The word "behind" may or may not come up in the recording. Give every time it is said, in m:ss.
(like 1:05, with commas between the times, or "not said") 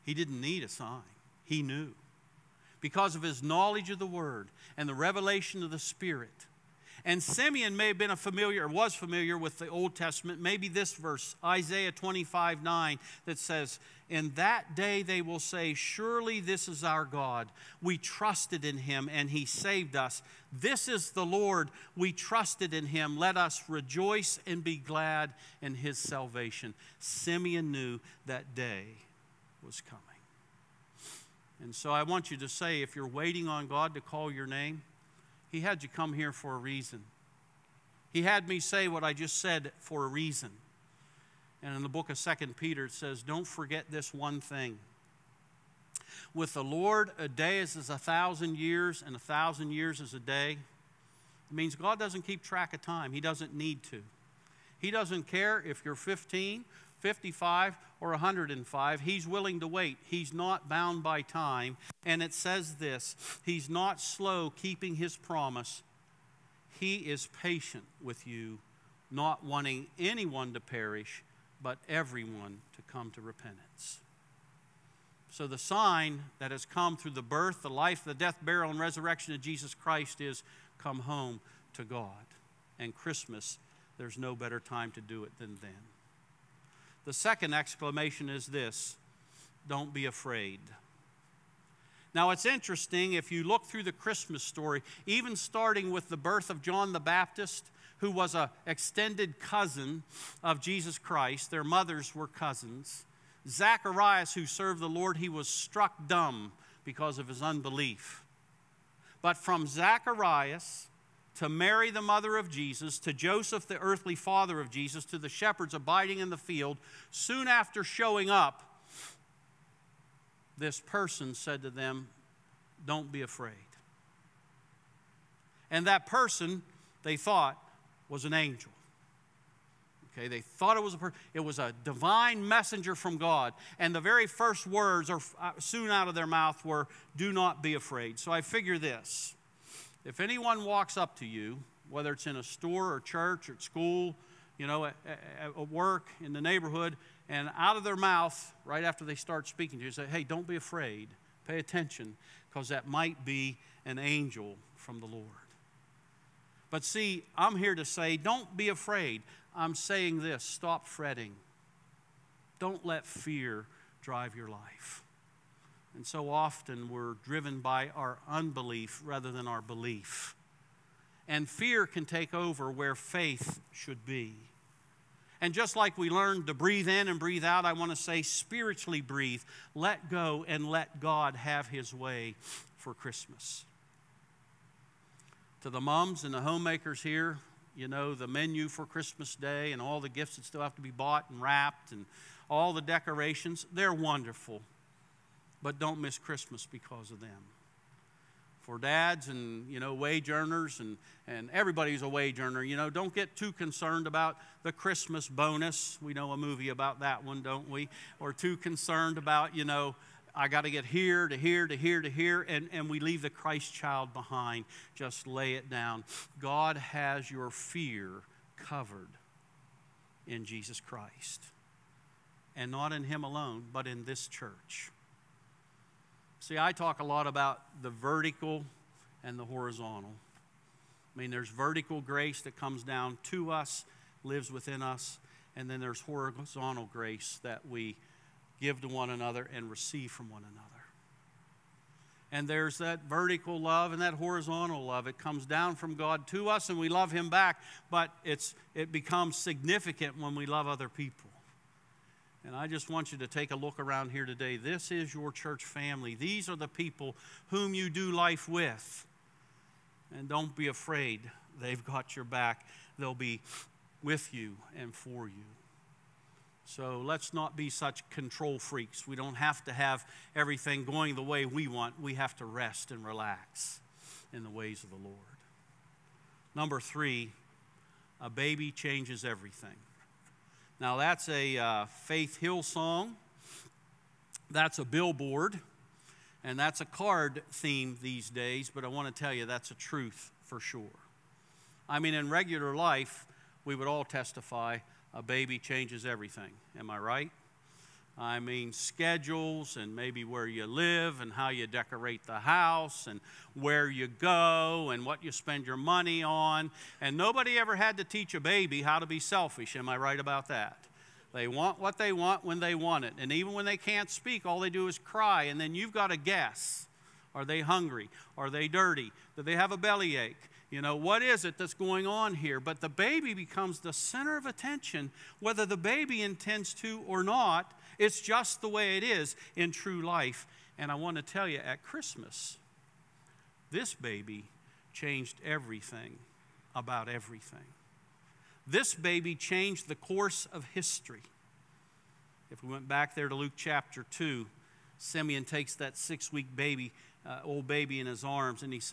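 3:34.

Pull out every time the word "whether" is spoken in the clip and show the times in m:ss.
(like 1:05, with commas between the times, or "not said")
2:21, 5:25.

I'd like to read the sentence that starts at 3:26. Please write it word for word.
We know a movie about that one, don't we?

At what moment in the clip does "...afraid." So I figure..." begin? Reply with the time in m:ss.
2:17.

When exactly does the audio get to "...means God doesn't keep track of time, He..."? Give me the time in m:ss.
0:51.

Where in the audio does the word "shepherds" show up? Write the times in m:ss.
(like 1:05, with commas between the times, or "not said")
1:55.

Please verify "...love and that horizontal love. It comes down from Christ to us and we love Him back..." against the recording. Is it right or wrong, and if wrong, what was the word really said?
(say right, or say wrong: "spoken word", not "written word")
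wrong: "God", not "Christ".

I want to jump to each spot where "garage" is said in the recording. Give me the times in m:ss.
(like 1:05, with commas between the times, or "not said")
not said.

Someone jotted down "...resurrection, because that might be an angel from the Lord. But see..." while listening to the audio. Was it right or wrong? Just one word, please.
wrong.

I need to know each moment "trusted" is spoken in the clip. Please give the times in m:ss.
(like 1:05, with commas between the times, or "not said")
0:17, 0:22.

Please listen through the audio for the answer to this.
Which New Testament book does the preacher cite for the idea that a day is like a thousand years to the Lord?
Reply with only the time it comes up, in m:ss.
0:42.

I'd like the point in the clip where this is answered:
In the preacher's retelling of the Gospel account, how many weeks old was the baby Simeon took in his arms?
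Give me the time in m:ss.
5:45.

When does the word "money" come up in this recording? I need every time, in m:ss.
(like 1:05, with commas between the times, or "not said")
5:05.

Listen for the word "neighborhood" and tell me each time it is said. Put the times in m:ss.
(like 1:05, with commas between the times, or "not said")
2:26.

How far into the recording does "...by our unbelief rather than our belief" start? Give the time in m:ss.
2:47.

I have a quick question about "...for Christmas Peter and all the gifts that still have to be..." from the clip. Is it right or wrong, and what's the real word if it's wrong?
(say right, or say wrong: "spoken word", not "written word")
wrong: "Day", not "Peter".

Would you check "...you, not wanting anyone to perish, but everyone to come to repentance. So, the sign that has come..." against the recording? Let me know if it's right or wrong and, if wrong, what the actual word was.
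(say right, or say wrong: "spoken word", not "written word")
right.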